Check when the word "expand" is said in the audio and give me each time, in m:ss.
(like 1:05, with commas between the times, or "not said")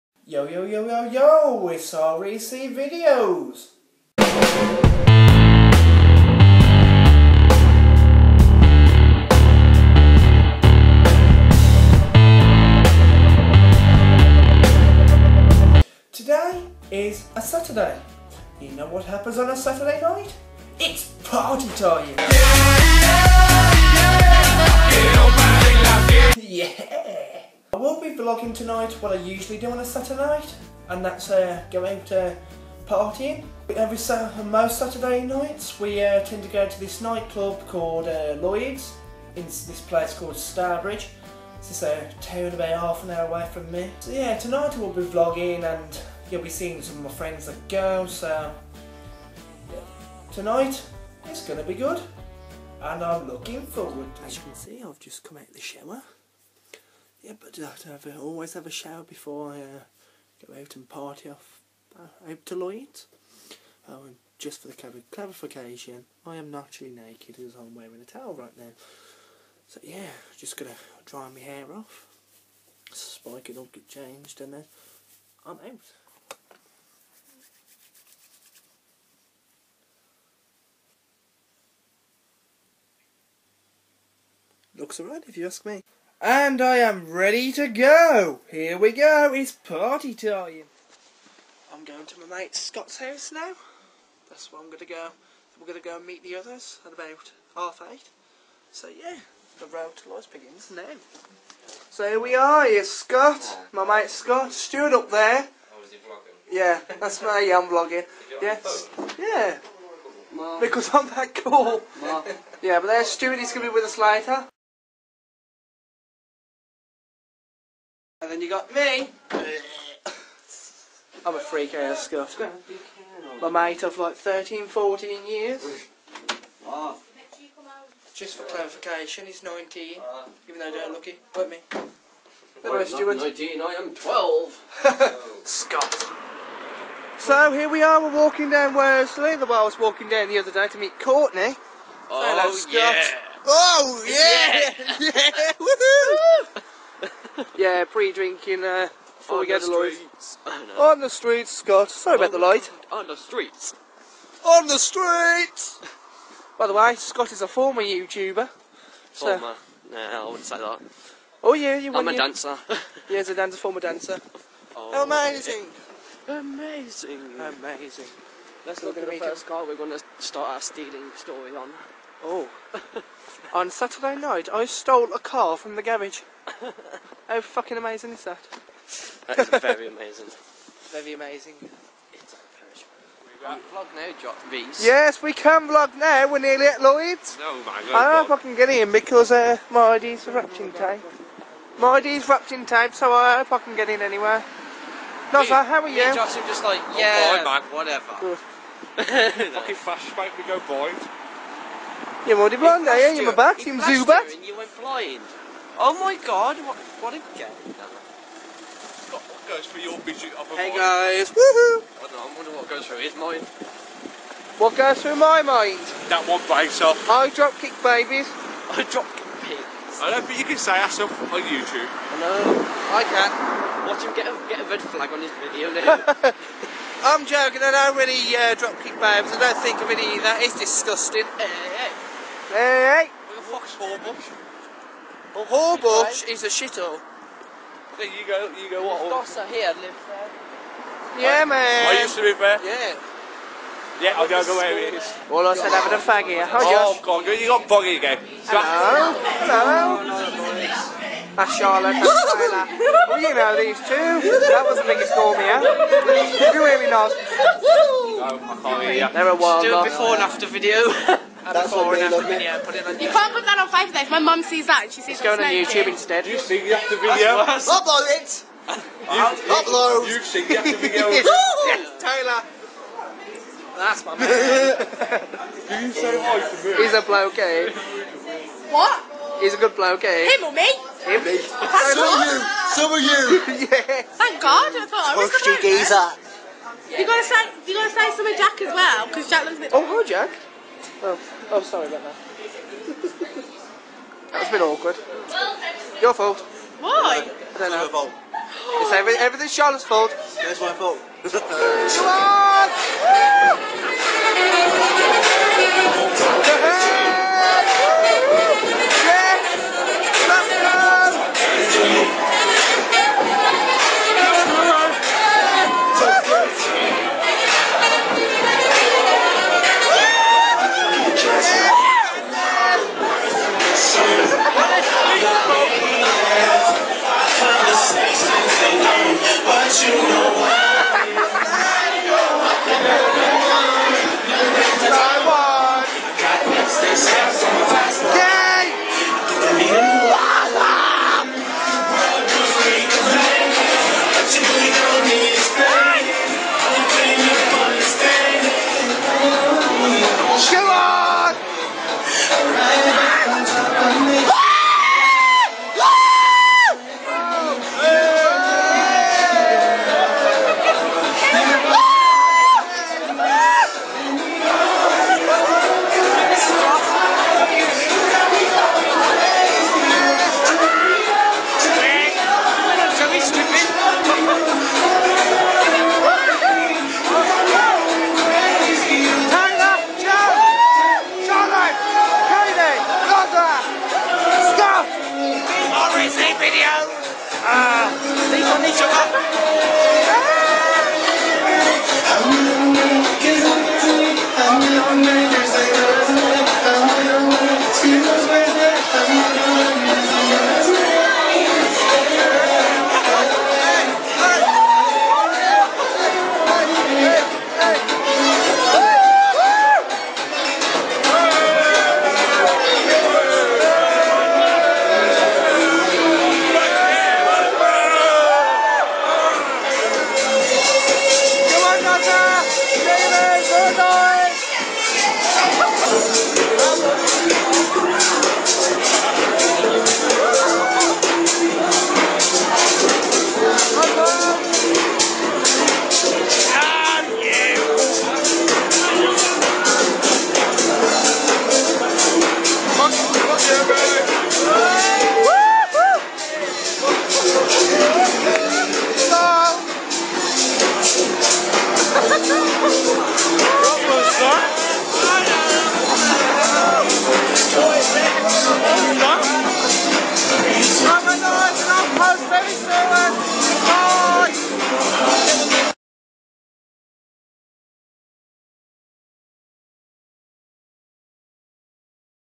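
not said.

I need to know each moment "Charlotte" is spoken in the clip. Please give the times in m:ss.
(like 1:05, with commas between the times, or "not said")
4:11, 4:59.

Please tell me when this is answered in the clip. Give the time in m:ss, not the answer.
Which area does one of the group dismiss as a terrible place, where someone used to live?
3:55.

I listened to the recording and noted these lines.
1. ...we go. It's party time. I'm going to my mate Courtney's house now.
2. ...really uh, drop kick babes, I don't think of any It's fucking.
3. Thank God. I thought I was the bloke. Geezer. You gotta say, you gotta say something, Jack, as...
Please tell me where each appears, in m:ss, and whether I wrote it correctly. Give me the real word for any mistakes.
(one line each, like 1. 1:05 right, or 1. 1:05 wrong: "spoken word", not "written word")
1. 1:28 wrong: "Scott", not "Courtney"
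2. 3:47 wrong: "disgusting", not "fucking"
3. 4:44 right.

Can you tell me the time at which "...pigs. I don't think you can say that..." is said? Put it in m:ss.
3:39.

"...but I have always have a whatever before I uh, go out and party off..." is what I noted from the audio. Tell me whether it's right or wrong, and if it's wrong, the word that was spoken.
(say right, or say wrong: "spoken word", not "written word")
wrong: "shower", not "whatever".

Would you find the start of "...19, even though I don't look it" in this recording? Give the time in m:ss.
2:09.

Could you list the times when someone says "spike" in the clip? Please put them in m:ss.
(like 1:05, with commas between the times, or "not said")
1:12.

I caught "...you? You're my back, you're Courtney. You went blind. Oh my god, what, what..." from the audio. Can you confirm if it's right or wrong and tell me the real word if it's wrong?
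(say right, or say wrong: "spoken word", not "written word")
wrong: "Zubat", not "Courtney".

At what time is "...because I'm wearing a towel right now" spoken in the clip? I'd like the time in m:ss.
1:07.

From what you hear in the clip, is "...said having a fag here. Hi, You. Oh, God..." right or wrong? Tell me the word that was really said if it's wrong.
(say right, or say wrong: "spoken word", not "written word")
wrong: "Josh", not "You".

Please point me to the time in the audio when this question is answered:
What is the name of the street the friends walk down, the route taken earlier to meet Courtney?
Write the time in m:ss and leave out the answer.
2:18.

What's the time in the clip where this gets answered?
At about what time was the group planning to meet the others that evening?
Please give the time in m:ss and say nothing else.
1:37.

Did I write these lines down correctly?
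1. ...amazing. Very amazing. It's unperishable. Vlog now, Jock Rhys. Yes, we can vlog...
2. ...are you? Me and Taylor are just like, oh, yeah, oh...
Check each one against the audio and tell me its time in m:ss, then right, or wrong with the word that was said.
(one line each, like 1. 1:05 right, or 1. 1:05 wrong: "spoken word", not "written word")
1. 2:59 right
2. 3:15 wrong: "Josh", not "Taylor".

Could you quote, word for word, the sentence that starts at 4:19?
They're a wild Just do it before and after video.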